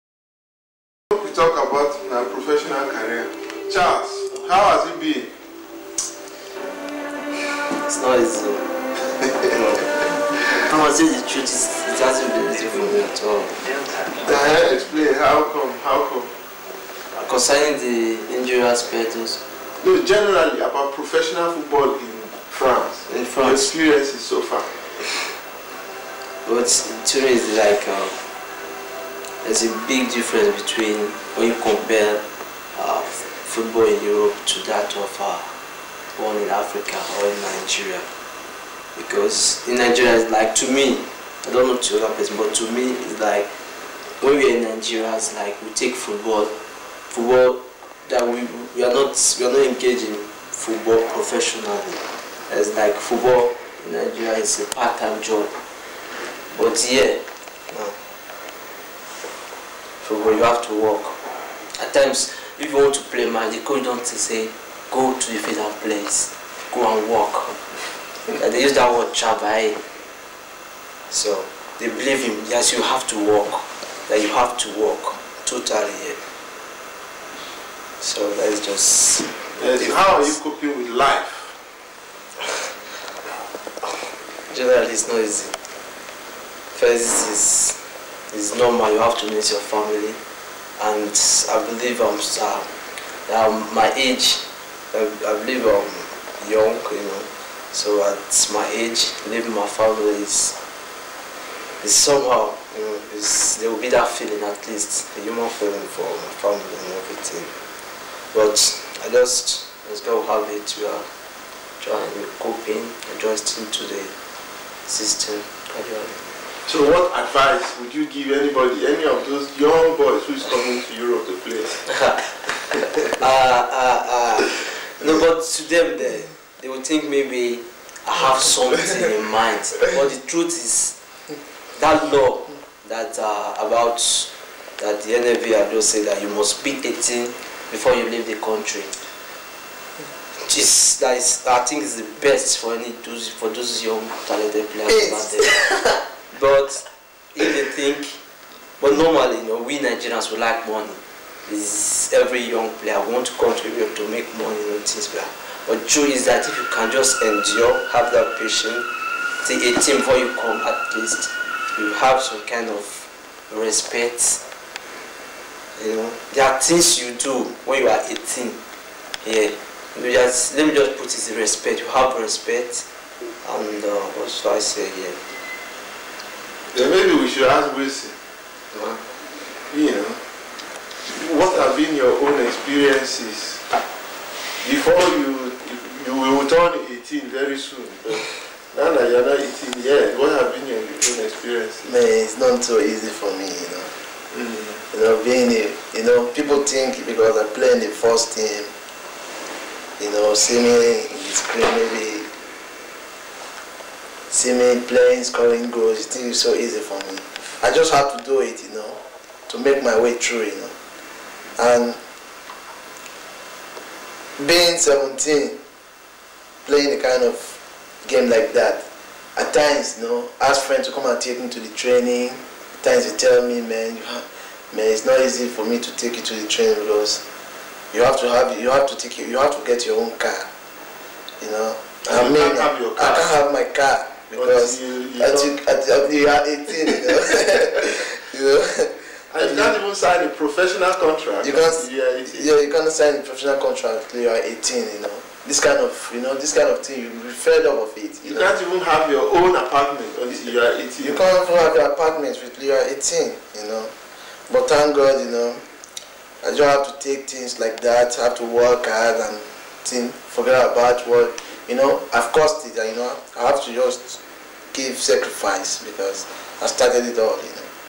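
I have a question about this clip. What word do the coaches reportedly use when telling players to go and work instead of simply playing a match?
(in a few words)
chabai.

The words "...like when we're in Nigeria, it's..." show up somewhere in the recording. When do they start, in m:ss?
0:43.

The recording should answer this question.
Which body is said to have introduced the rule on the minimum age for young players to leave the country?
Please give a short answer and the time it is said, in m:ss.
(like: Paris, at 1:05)
NFV, at 2:15.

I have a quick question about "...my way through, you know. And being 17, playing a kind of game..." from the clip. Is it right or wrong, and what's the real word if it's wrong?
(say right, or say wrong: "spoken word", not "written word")
right.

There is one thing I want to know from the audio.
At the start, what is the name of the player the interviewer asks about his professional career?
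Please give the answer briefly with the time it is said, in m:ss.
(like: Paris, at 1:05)
Charles, at 0:03.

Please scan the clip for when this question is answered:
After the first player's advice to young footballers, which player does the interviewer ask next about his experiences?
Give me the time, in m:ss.
2:57.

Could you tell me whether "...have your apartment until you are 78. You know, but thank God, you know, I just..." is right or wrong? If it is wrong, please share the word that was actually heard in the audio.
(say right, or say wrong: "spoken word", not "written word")
wrong: "18", not "78".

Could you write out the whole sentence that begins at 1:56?
So what advice would you give anybody, any of those young boys who is coming to Europe to play?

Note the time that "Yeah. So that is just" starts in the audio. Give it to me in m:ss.
1:16.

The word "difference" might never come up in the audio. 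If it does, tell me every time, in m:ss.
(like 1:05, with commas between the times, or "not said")
0:30.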